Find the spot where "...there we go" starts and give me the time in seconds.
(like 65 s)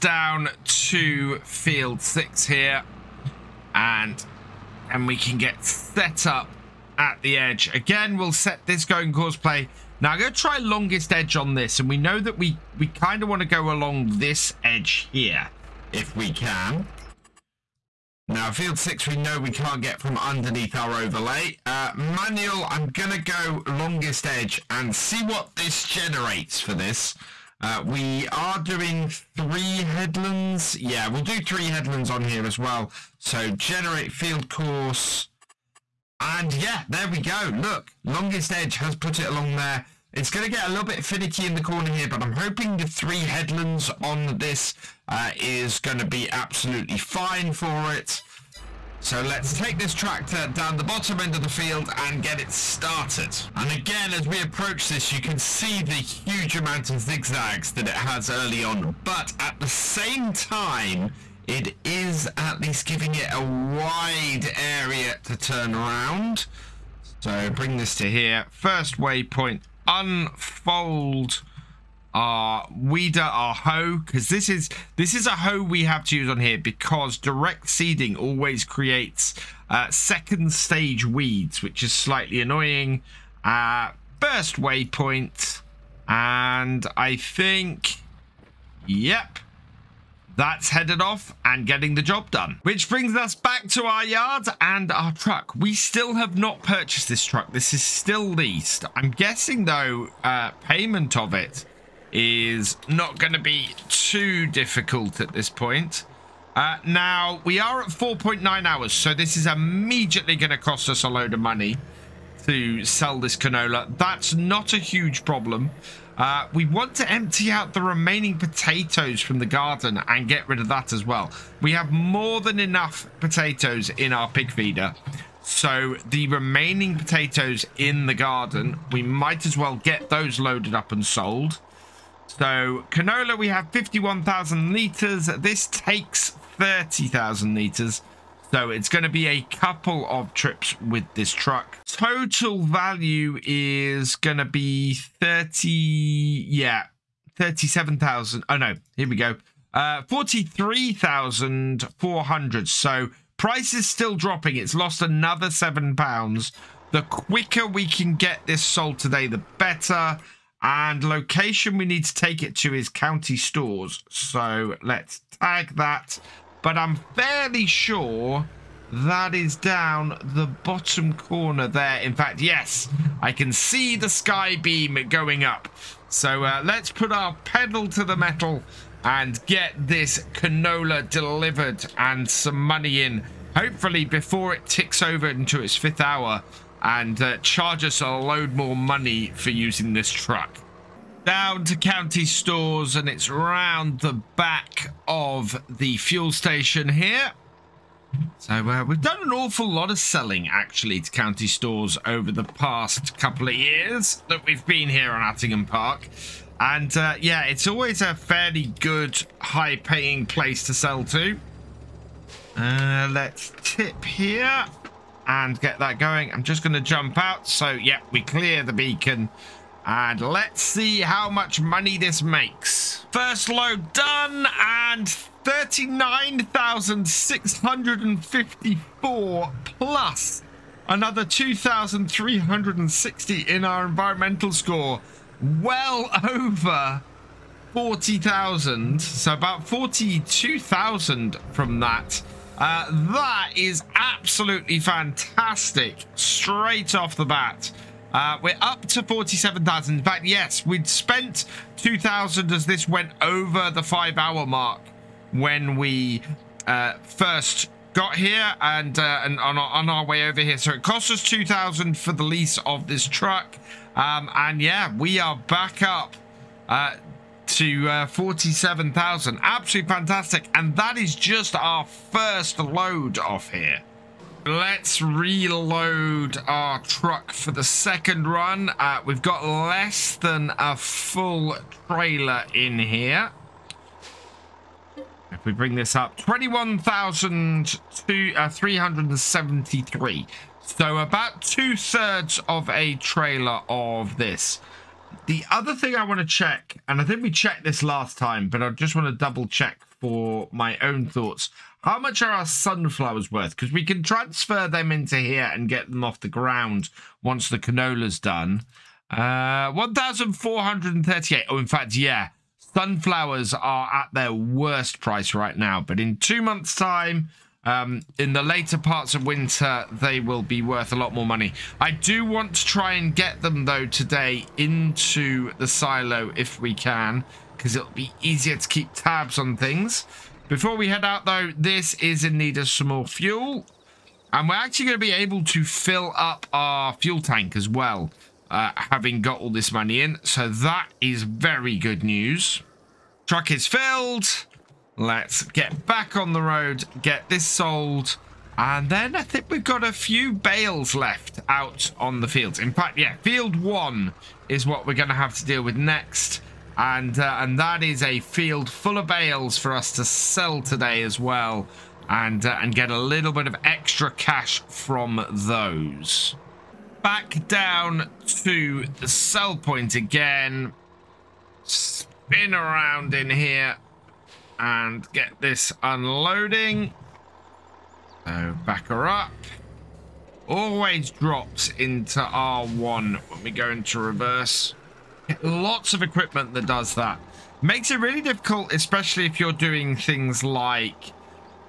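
36 s.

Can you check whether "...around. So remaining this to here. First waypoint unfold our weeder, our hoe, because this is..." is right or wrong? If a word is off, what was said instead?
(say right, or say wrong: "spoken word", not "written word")
wrong: "bring", not "remaining".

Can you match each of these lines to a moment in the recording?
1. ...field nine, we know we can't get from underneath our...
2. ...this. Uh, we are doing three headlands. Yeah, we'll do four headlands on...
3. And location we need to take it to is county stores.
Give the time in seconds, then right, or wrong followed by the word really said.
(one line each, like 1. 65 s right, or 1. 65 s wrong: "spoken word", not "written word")
1. 18 s wrong: "six", not "nine"
2. 26 s wrong: "three", not "four"
3. 160 s right.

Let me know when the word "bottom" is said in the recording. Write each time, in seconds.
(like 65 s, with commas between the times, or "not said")
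50 s, 170 s.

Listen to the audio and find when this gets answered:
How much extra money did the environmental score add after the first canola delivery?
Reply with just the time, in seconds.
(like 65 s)
231 s.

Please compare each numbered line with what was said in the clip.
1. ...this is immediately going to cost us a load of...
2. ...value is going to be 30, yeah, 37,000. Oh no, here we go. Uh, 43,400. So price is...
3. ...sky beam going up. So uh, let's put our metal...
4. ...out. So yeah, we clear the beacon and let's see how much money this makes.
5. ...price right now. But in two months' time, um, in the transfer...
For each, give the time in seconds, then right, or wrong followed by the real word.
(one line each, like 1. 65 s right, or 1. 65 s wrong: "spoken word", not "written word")
1. 109 s right
2. 142 s right
3. 174 s wrong: "pedal", not "metal"
4. 217 s right
5. 314 s wrong: "later", not "transfer".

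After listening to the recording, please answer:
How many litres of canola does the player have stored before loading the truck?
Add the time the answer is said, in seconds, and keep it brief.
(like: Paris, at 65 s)
51,000 litres, at 133 s.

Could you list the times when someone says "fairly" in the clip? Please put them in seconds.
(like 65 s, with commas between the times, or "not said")
167 s, 208 s.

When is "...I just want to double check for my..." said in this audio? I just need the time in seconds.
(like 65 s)
298 s.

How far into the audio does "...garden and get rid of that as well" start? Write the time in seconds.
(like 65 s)
119 s.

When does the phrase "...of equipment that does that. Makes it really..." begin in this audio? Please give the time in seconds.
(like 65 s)
385 s.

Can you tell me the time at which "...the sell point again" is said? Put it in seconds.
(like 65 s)
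368 s.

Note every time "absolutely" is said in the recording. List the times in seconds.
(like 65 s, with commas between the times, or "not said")
46 s, 243 s, 269 s.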